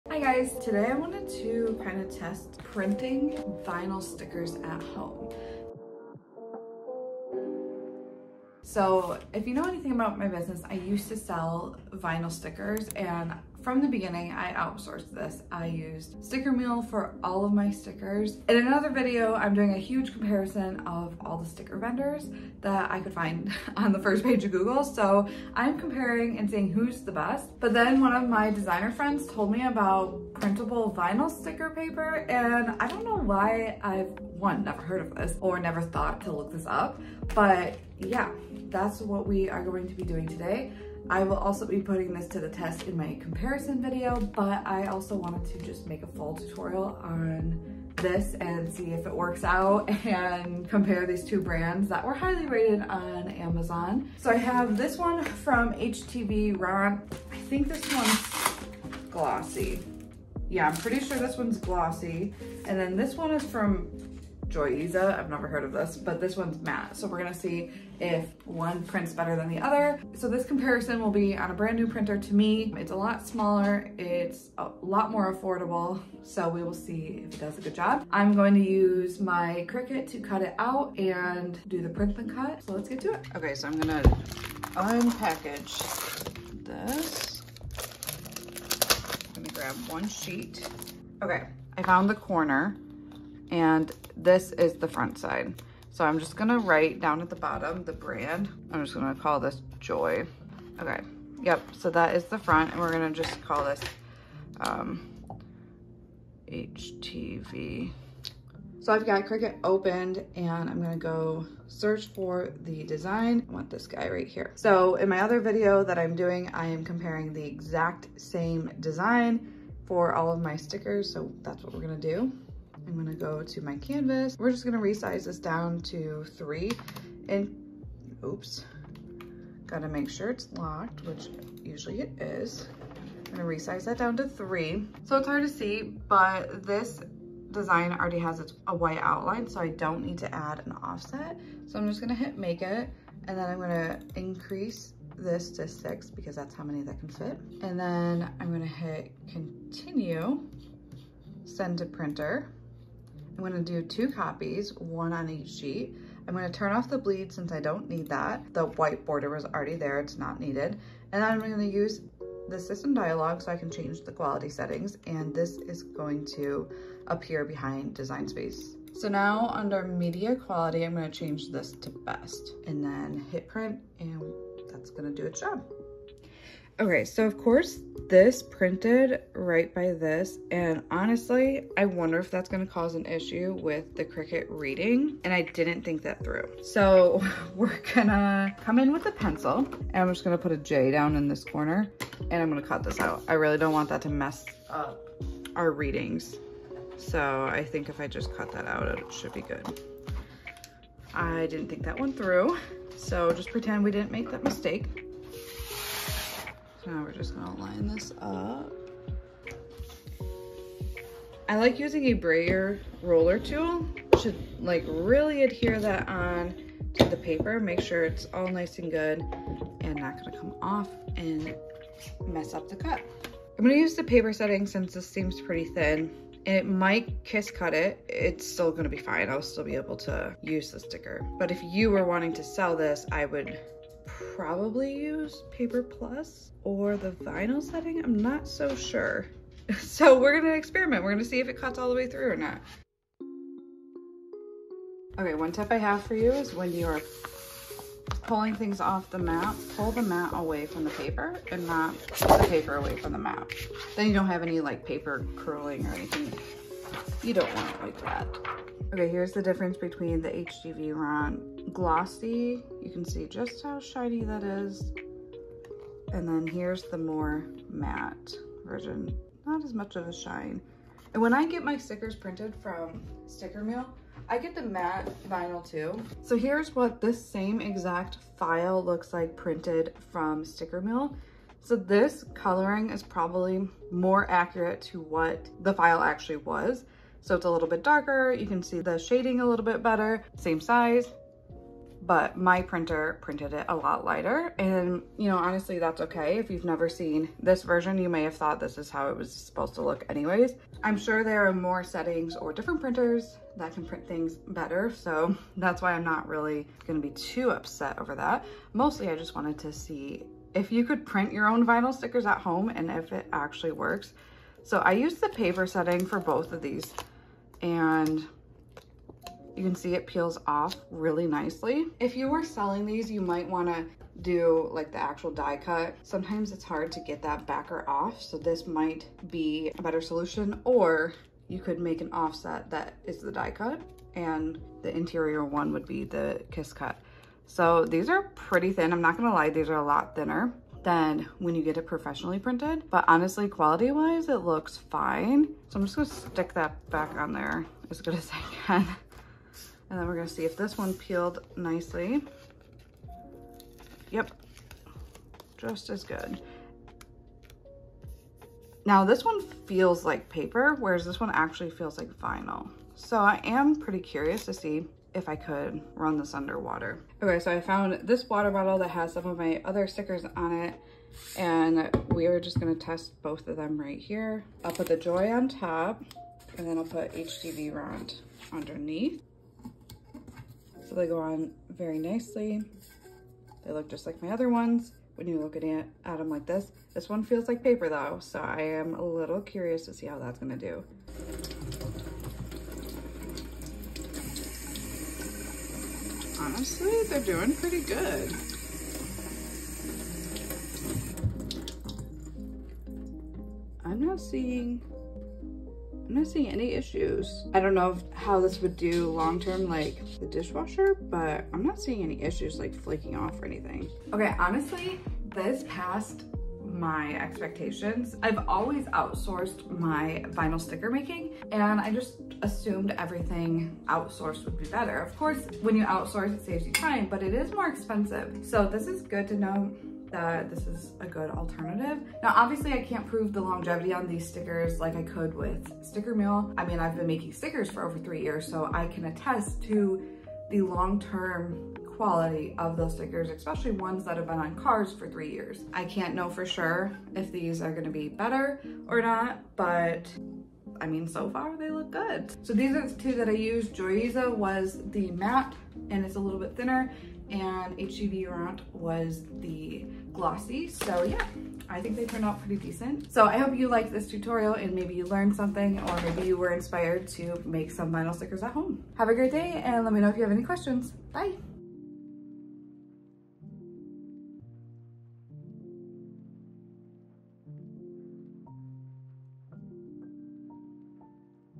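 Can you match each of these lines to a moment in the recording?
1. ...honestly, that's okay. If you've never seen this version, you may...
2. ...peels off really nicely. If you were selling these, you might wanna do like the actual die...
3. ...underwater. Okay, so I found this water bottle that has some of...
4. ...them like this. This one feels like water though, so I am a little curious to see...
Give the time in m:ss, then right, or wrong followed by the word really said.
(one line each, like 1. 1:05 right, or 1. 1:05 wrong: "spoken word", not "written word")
1. 4:55 right
2. 5:20 right
3. 6:06 right
4. 6:26 wrong: "paper", not "water".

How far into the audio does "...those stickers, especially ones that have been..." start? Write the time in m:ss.
7:22.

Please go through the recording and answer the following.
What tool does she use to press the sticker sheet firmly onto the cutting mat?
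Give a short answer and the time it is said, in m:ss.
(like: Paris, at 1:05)
brayer roller, at 3:31.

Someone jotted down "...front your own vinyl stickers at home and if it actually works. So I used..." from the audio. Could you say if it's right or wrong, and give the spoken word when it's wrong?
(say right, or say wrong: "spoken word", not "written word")
wrong: "print", not "front".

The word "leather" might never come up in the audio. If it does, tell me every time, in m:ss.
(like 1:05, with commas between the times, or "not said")
not said.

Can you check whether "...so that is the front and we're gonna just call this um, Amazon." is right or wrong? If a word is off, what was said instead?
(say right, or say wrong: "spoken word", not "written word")
wrong: "HTV", not "Amazon".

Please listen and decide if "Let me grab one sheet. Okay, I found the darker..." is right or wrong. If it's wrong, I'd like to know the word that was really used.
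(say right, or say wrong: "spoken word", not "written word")
wrong: "corner", not "darker".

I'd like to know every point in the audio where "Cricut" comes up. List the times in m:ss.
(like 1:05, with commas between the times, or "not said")
1:19, 1:49, 3:04.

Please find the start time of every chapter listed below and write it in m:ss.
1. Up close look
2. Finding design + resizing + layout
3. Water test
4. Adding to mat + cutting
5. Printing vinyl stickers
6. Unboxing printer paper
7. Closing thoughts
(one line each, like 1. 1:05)
1. 4:11
2. 1:49
3. 6:31
4. 3:25
5. 2:30
6. 1:24
7. 6:54.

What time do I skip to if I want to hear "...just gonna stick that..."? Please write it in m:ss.
5:45.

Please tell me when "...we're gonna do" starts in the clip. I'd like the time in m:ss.
2:01.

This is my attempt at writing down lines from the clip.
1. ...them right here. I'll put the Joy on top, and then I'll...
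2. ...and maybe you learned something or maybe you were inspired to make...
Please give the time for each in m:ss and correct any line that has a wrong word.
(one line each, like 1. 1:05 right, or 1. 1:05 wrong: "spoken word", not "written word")
1. 6:13 right
2. 7:44 right.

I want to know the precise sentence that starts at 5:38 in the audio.
I'm not gonna lie, these are a lot thinner than when you get it professionally printed.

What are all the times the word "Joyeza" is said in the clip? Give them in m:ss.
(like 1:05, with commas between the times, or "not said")
1:04, 7:33.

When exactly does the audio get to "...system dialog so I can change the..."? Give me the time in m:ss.
2:42.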